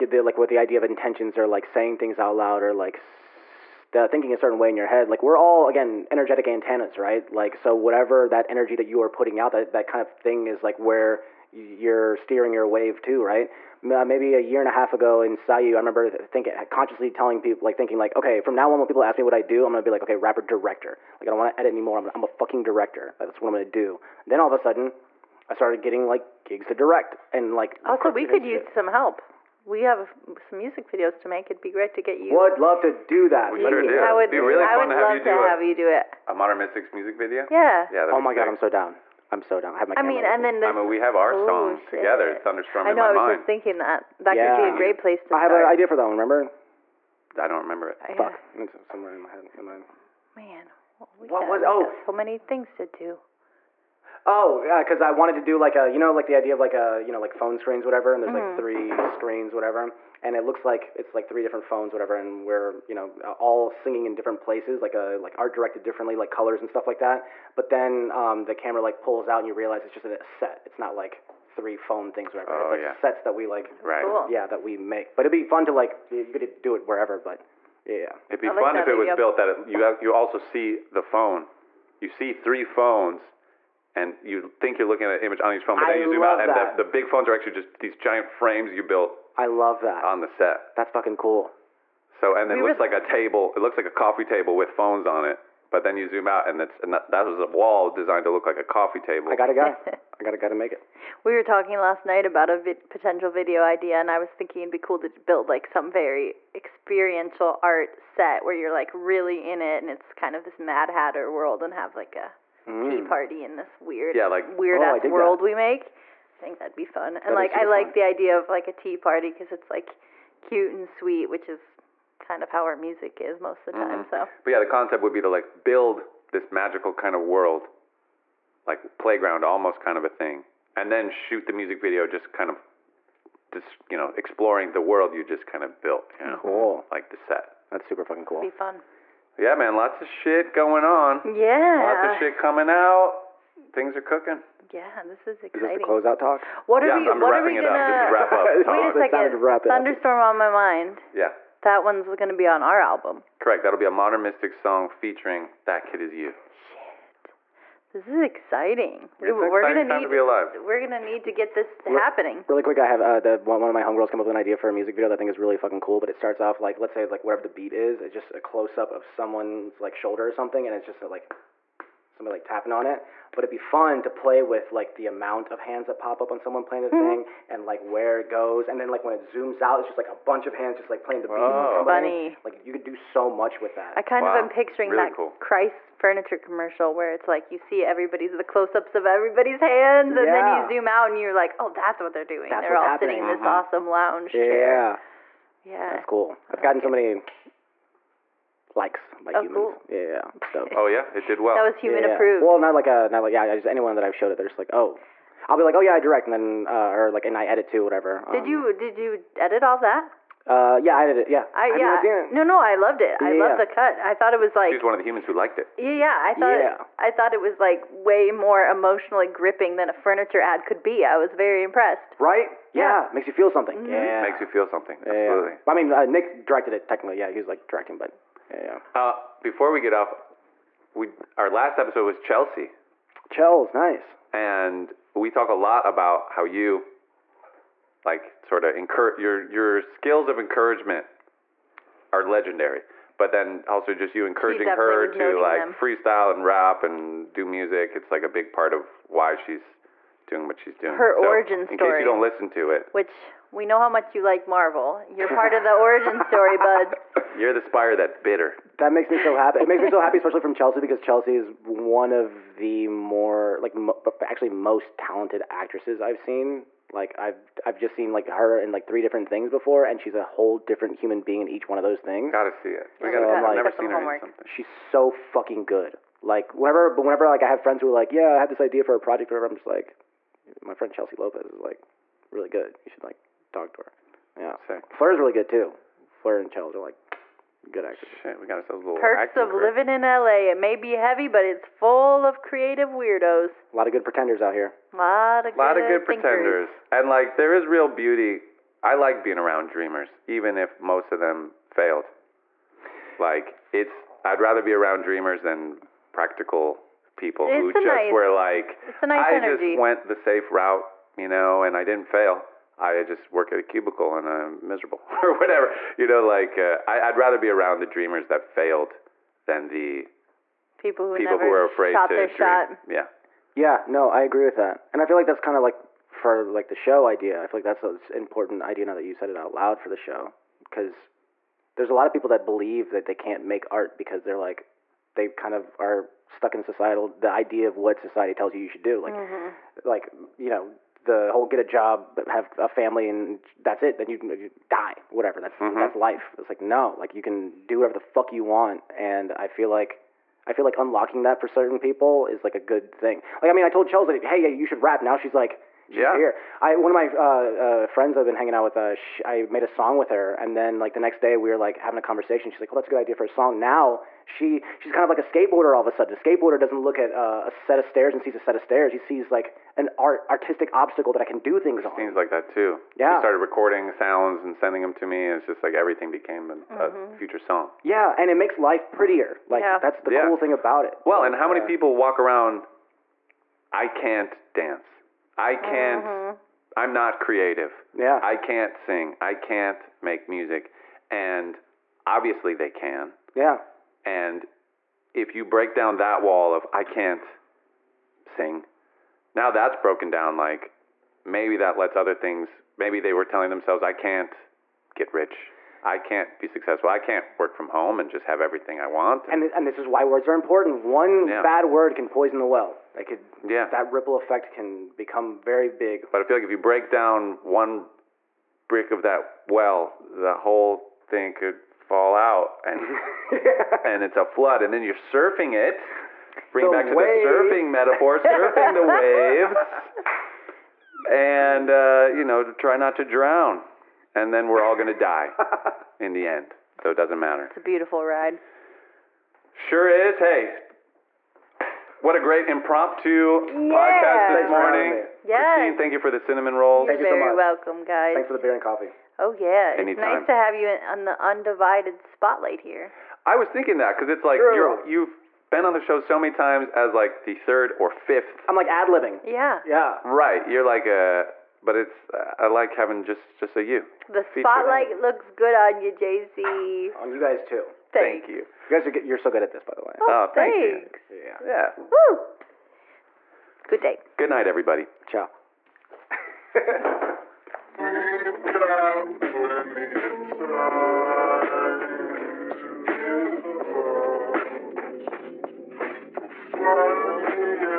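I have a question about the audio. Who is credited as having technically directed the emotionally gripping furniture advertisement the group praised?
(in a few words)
Nick.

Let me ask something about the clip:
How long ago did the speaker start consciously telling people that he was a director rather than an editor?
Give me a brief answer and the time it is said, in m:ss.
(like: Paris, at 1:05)
A year and a half, at 0:14.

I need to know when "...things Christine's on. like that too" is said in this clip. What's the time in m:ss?
6:11.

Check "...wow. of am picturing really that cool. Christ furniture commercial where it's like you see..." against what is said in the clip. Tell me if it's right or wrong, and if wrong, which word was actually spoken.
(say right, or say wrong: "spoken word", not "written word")
right.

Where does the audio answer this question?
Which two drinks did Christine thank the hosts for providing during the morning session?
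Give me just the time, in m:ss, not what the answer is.
7:28.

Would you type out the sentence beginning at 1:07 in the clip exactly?
But then um, the camera like pulls out and you realize it's just a set.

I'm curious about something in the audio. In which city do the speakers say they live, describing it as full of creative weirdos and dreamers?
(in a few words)
LA.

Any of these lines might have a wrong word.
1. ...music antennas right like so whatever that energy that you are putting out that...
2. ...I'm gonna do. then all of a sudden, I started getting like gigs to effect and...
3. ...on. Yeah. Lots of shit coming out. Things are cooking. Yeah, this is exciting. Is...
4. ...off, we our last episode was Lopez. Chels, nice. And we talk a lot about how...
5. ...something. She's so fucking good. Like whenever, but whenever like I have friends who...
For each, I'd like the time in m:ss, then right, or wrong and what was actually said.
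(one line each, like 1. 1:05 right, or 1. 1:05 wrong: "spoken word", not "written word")
1. 0:06 wrong: "energetic", not "music"
2. 0:23 wrong: "direct", not "effect"
3. 2:20 right
4. 3:49 wrong: "Chelsea", not "Lopez"
5. 4:34 right.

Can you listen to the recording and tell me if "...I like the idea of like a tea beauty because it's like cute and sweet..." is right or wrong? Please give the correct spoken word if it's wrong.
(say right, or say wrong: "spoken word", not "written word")
wrong: "party", not "beauty".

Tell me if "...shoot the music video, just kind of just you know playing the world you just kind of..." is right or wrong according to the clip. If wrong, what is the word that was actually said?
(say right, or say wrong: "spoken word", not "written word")
wrong: "exploring", not "playing".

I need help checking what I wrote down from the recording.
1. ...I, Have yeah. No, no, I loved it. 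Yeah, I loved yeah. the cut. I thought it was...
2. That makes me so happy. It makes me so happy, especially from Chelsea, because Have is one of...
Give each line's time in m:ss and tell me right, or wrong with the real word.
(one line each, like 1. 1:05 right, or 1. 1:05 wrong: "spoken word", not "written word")
1. 3:31 right
2. 4:18 wrong: "Chelsea", not "Have".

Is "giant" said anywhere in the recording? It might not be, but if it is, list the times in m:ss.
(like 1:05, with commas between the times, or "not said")
1:27.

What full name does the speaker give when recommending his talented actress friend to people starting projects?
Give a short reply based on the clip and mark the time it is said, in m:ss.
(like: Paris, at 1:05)
Chelsea Lopez, at 4:40.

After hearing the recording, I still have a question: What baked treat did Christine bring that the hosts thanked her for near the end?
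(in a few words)
Cinnamon rolls.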